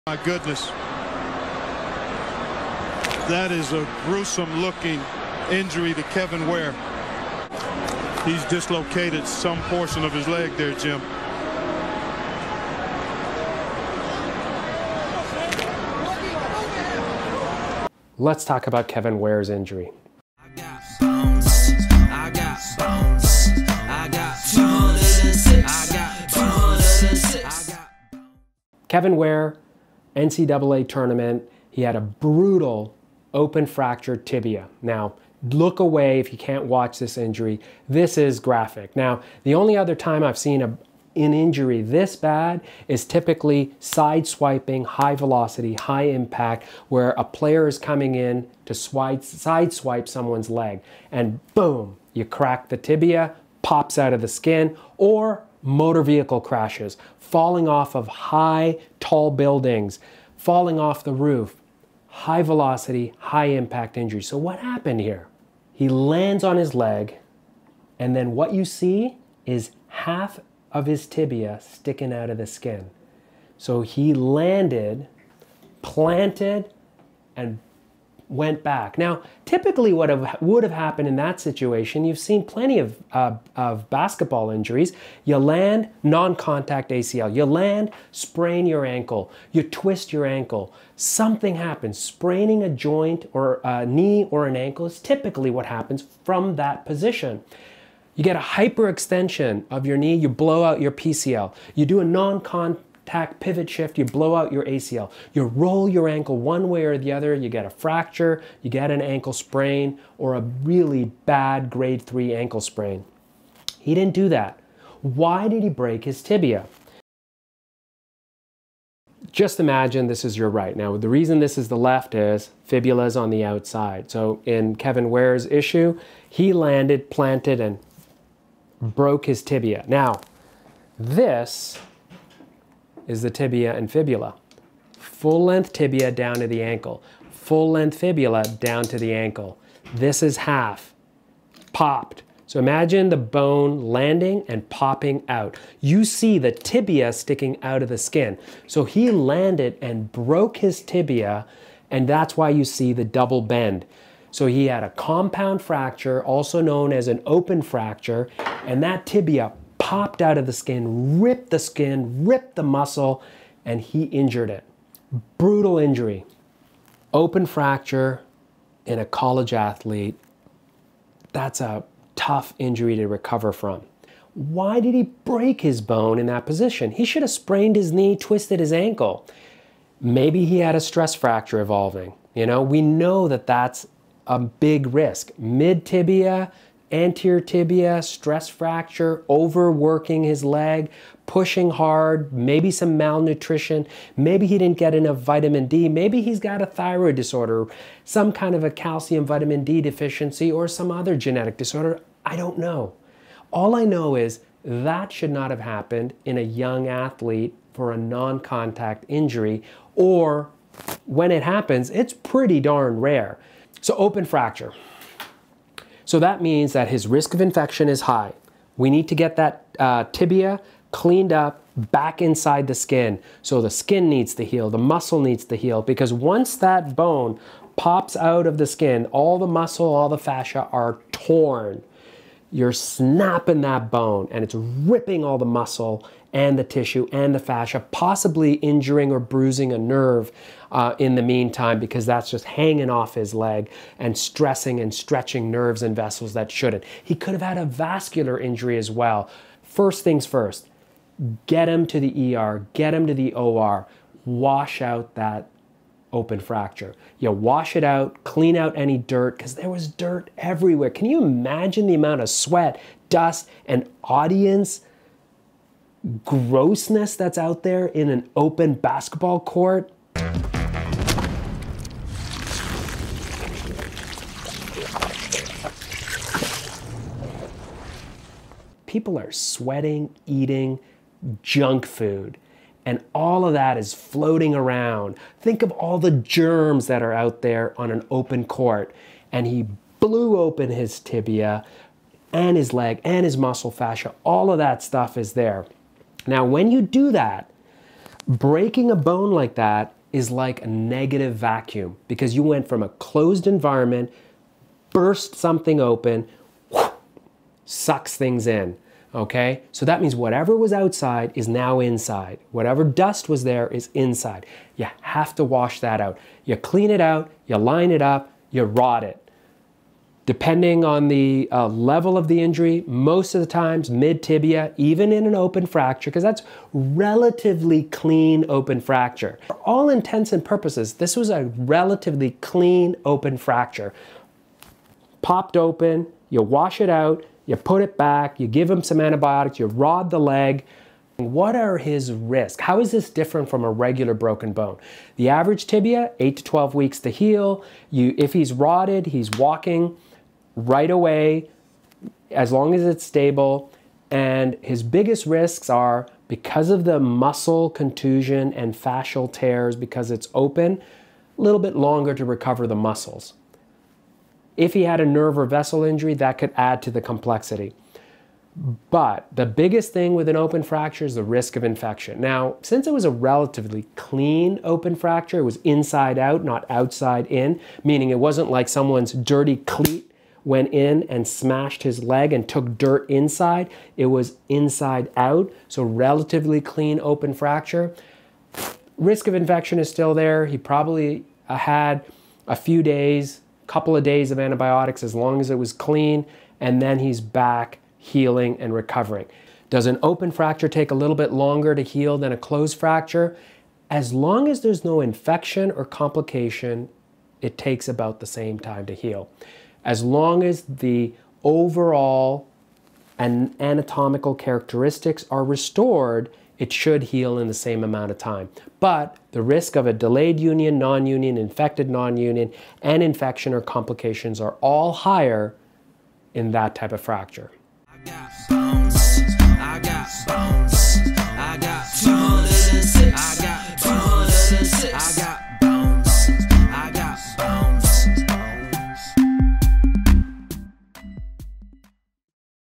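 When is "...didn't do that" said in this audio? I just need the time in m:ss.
1:53.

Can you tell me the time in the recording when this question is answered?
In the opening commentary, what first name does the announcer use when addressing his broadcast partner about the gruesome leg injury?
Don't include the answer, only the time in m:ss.
0:10.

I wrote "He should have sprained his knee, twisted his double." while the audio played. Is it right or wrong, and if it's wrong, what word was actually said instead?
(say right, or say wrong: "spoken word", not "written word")
wrong: "ankle", not "double".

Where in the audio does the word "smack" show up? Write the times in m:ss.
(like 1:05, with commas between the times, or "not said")
not said.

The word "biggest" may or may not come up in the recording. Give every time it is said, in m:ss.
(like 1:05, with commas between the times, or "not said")
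5:54, 6:09.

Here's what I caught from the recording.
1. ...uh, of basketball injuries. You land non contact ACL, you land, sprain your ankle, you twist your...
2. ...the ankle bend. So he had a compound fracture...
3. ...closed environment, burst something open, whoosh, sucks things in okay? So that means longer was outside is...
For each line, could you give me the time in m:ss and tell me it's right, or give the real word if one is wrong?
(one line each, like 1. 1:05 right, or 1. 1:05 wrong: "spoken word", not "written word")
1. 1:23 right
2. 2:32 wrong: "double", not "ankle"
3. 5:02 wrong: "whatever", not "longer".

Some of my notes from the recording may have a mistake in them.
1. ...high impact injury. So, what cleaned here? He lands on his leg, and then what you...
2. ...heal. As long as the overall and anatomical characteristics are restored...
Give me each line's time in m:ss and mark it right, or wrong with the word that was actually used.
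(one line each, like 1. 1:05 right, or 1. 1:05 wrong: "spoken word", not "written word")
1. 1:03 wrong: "happened", not "cleaned"
2. 6:48 right.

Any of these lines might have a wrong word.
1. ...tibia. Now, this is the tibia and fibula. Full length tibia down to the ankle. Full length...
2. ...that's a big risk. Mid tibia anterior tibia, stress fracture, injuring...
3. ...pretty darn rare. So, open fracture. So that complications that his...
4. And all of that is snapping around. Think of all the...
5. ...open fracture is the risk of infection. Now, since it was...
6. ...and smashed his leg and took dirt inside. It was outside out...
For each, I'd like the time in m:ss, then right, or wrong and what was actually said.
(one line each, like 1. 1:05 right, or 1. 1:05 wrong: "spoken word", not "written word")
1. 2:09 right
2. 3:03 wrong: "overworking", not "injuring"
3. 3:32 wrong: "means", not "complications"
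4. 4:42 wrong: "floating", not "snapping"
5. 6:10 right
6. 6:21 wrong: "inside", not "outside".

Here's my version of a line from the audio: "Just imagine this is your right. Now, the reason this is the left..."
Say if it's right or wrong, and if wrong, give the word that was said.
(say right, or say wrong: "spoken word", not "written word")
right.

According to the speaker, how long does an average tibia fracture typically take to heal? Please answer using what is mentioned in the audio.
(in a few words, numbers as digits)
8 to 12 weeks.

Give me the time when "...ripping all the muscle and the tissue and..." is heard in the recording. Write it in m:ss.
3:54.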